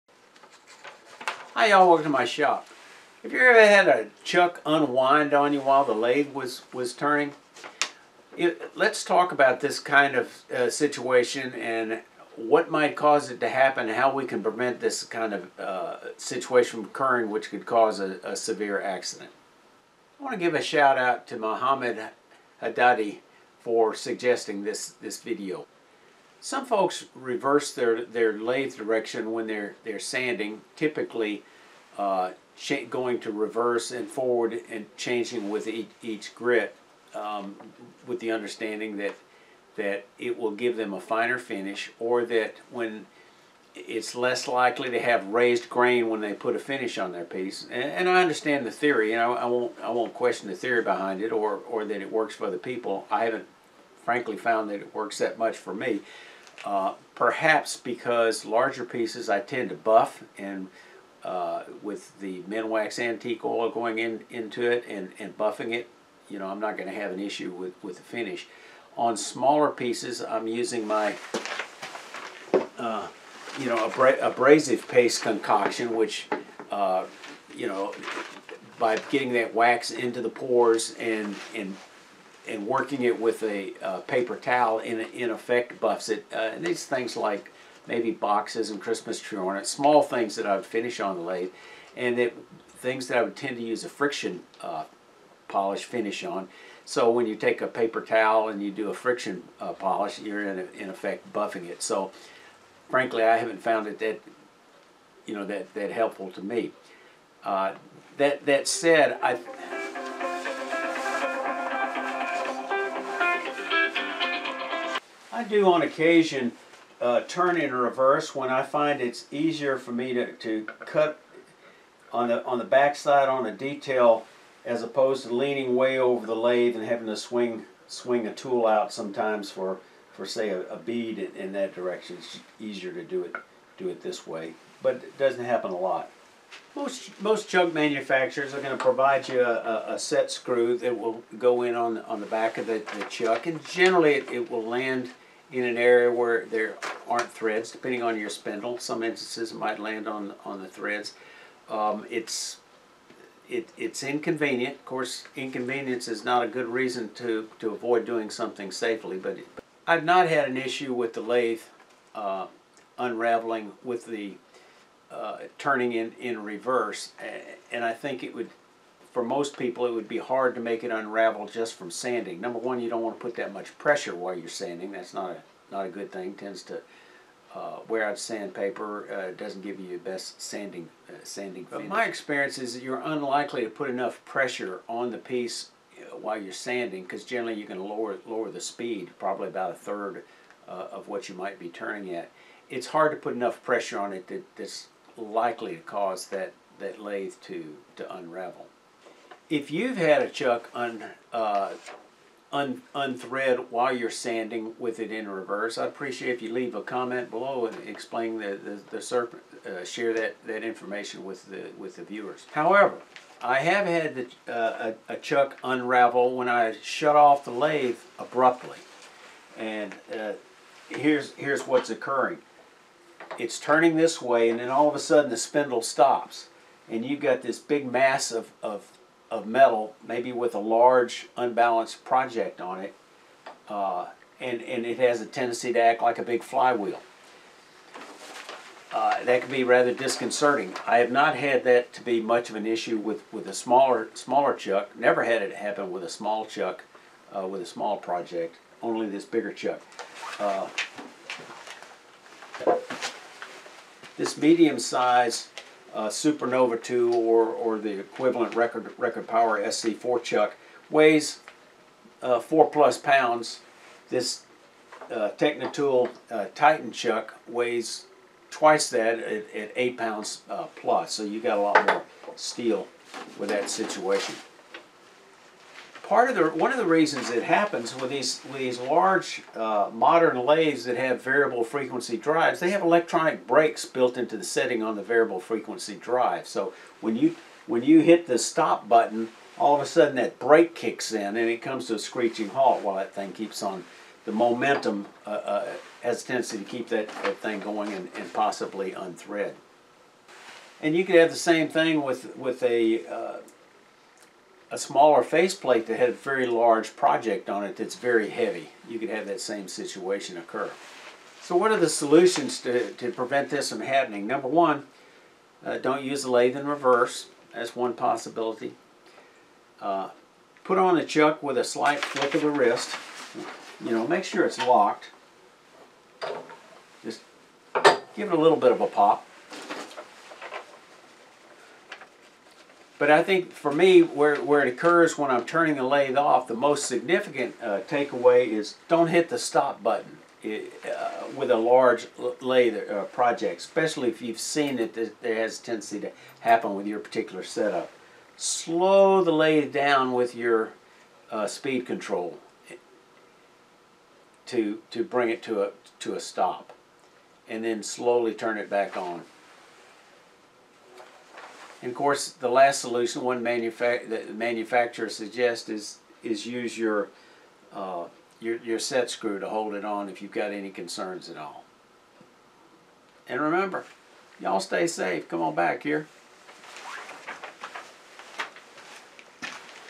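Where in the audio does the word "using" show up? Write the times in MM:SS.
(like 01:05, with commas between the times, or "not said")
01:10.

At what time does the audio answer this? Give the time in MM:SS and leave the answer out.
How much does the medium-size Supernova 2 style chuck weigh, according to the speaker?
04:22.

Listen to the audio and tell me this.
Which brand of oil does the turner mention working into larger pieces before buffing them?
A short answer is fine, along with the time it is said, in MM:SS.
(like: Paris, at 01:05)
Minwax antique oil, at 01:02.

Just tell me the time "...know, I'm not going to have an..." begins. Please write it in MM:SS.
01:06.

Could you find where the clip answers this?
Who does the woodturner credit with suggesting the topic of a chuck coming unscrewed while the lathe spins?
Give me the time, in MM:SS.
00:21.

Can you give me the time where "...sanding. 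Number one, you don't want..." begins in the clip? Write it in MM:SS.
02:51.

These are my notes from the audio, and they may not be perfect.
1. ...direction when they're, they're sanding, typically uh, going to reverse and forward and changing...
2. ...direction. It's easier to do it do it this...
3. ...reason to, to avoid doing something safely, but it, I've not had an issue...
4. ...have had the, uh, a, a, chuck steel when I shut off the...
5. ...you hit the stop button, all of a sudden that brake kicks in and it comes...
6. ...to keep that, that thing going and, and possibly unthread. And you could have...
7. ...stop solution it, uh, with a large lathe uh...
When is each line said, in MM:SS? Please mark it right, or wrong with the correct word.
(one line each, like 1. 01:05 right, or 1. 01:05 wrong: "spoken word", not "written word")
1. 00:28 right
2. 02:11 right
3. 02:36 right
4. 03:33 wrong: "unravel", not "steel"
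5. 04:47 right
6. 04:56 right
7. 05:39 wrong: "button", not "solution".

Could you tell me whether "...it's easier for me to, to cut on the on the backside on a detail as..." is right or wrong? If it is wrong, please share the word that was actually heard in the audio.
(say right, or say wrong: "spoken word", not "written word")
right.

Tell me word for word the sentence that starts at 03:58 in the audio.
Uh, that can be rather disconcerting.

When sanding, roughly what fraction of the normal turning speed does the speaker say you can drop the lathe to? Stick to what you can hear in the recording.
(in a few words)
a third.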